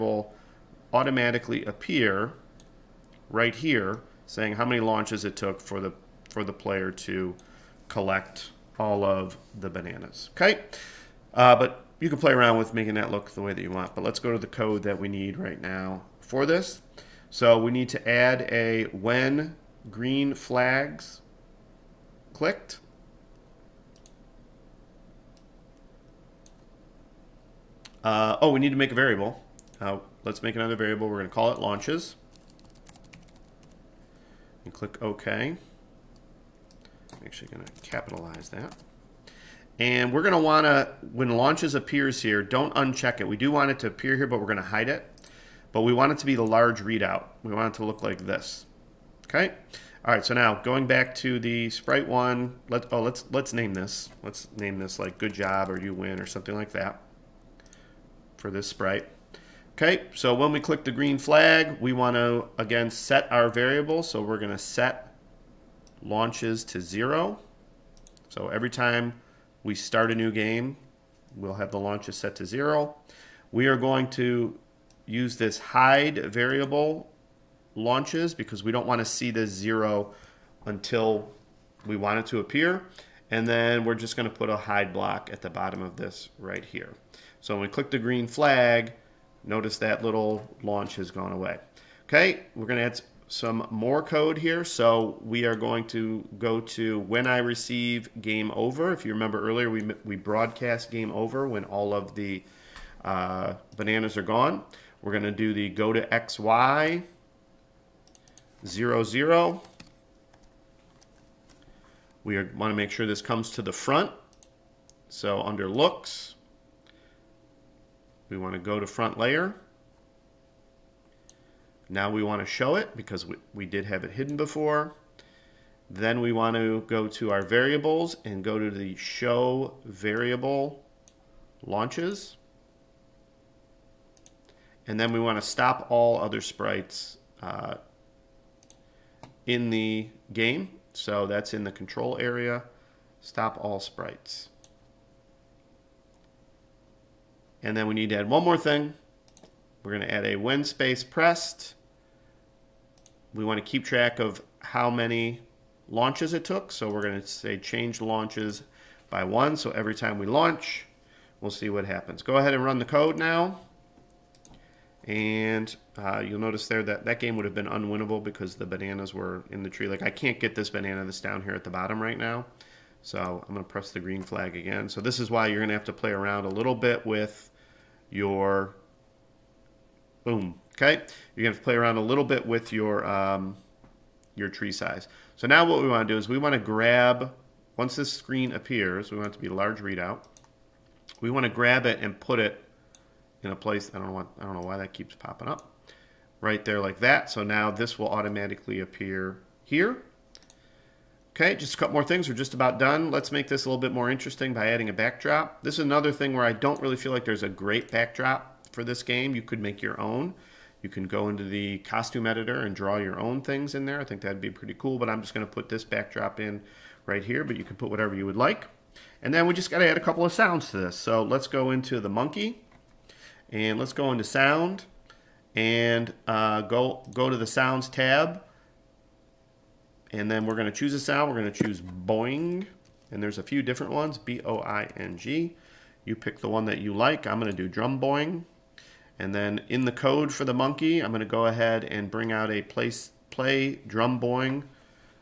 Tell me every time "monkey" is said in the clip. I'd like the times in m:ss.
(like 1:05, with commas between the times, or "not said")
3:42, 4:00.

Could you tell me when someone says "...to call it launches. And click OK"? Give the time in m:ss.
0:31.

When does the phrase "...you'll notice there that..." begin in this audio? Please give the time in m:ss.
2:46.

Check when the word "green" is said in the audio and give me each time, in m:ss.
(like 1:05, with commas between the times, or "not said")
0:19, 1:00, 1:27, 2:53.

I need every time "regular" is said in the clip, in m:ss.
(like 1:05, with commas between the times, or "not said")
not said.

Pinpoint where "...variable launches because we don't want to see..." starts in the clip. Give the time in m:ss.
1:16.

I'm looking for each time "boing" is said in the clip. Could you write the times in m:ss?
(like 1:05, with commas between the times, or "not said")
3:51, 3:57, 4:04.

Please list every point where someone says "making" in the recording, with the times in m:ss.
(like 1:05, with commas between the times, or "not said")
0:12.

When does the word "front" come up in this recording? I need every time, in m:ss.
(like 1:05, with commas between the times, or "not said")
1:53, 1:58.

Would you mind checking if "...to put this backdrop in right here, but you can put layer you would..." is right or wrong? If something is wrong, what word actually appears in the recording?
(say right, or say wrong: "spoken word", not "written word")
wrong: "whatever", not "layer".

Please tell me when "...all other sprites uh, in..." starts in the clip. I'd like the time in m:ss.
2:15.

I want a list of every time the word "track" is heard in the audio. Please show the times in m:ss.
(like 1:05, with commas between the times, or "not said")
2:33.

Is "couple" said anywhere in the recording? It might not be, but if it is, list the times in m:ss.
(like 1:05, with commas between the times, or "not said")
3:21, 3:40.